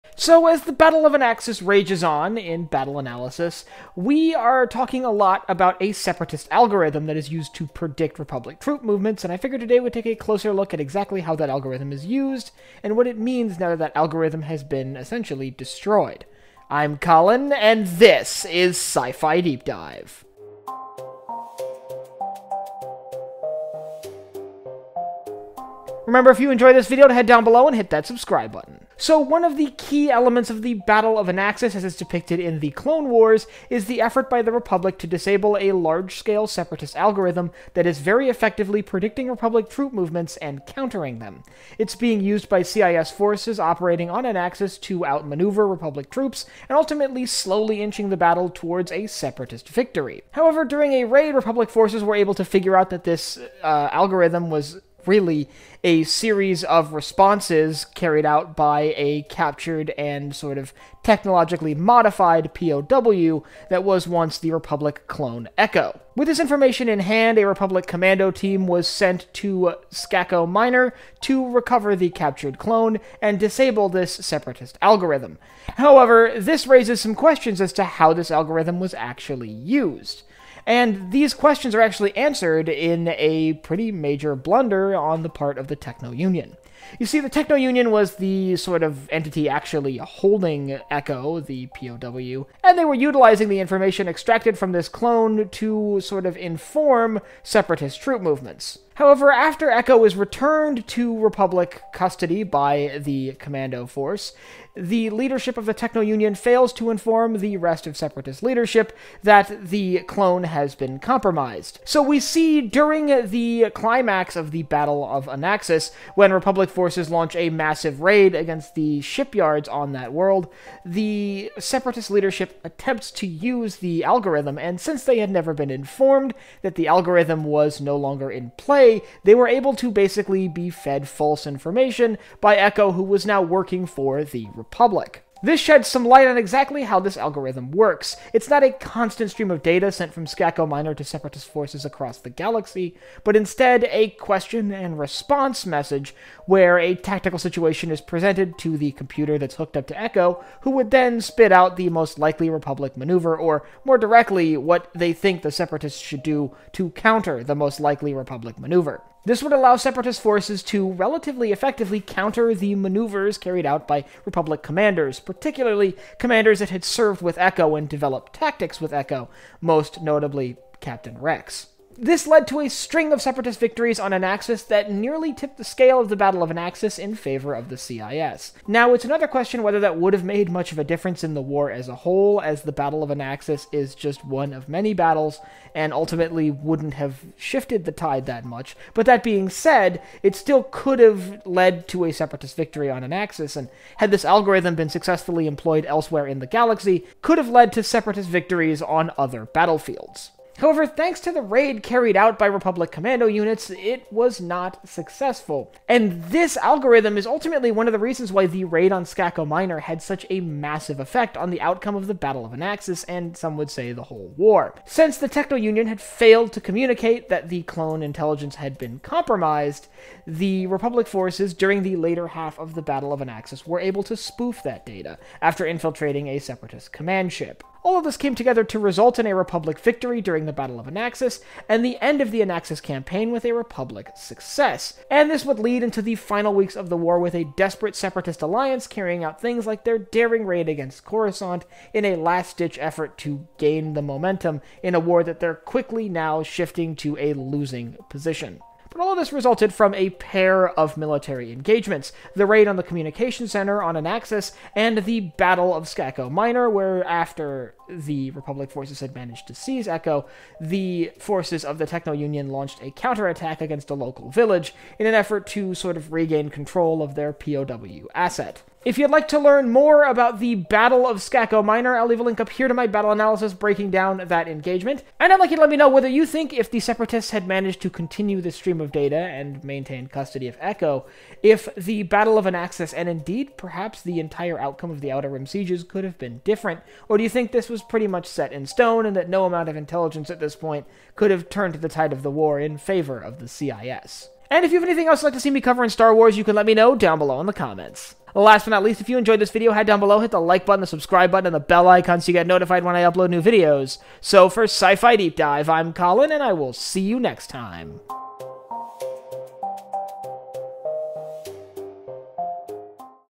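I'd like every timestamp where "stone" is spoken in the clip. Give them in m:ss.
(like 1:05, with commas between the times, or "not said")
4:48.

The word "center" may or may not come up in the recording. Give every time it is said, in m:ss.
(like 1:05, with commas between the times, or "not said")
4:13.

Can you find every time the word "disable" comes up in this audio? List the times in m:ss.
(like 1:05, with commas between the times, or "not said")
0:35, 1:13.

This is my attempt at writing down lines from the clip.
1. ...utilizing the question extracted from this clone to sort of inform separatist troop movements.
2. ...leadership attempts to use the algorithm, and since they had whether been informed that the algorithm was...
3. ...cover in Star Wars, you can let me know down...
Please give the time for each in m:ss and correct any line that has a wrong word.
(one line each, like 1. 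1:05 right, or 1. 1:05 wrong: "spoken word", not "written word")
1. 1:32 wrong: "information", not "question"
2. 2:02 wrong: "never", not "whether"
3. 4:55 right.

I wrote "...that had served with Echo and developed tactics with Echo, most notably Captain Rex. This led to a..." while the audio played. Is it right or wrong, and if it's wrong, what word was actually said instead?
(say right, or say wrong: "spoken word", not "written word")
right.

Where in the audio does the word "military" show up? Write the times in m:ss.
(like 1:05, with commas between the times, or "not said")
4:10.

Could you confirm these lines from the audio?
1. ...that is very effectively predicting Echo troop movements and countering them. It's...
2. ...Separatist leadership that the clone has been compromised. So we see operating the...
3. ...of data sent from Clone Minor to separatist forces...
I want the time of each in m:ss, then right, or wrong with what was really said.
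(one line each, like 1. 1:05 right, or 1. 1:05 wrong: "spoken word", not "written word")
1. 0:37 wrong: "Republic", not "Echo"
2. 1:47 wrong: "during", not "operating"
3. 2:19 wrong: "Skako", not "Clone".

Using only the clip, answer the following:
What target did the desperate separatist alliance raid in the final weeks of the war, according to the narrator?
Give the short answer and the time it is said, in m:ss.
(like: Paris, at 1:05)
Coruscant, at 4:01.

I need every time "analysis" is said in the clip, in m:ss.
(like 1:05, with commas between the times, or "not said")
0:02, 4:33.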